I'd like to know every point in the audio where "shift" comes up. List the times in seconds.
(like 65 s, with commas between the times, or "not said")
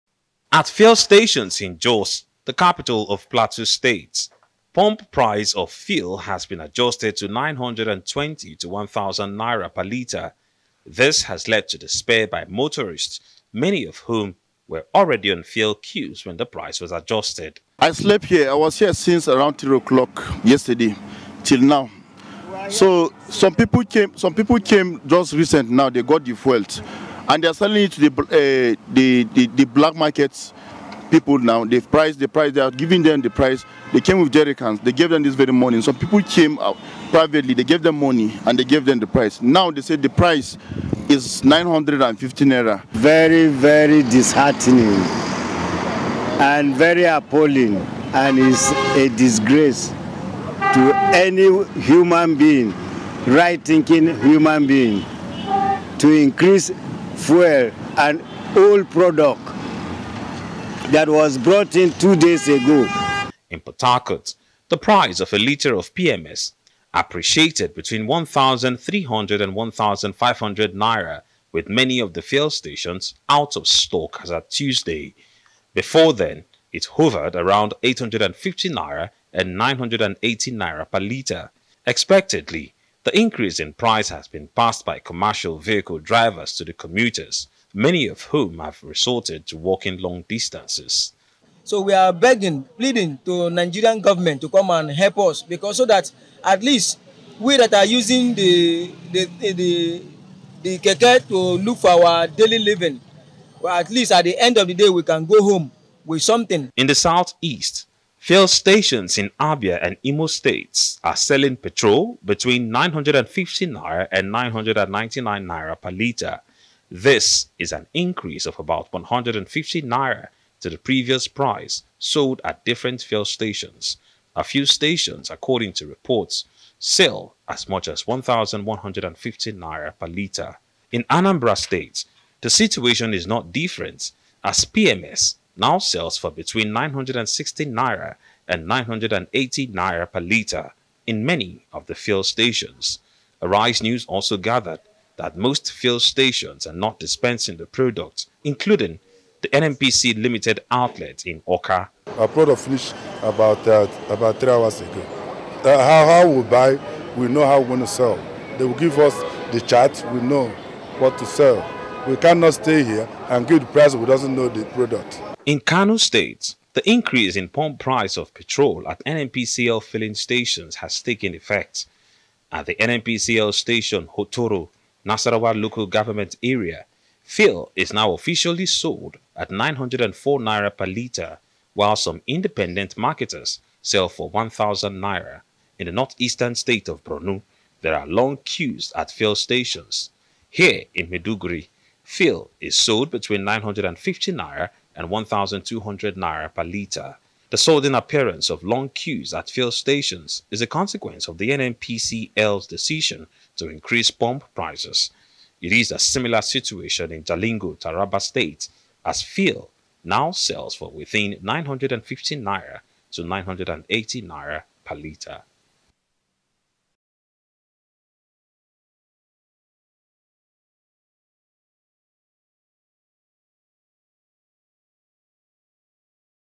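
not said.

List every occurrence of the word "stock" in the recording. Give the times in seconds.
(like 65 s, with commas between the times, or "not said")
73 s.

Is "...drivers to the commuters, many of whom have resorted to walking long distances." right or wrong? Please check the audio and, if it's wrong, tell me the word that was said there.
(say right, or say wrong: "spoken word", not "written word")
right.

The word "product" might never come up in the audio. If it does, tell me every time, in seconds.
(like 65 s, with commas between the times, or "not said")
58 s, 147 s, 152 s, 164 s.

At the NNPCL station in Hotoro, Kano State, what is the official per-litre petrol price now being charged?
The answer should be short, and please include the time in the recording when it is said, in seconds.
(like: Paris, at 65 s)
904 naira, at 179 s.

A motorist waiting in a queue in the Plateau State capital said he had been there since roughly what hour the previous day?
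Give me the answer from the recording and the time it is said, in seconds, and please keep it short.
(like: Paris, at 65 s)
3 o'clock, at 19 s.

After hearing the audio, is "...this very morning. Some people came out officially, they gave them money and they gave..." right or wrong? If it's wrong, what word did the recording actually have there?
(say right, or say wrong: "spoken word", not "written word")
wrong: "privately", not "officially".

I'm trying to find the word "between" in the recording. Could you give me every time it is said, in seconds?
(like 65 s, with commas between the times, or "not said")
67 s, 112 s, 136 s, 193 s.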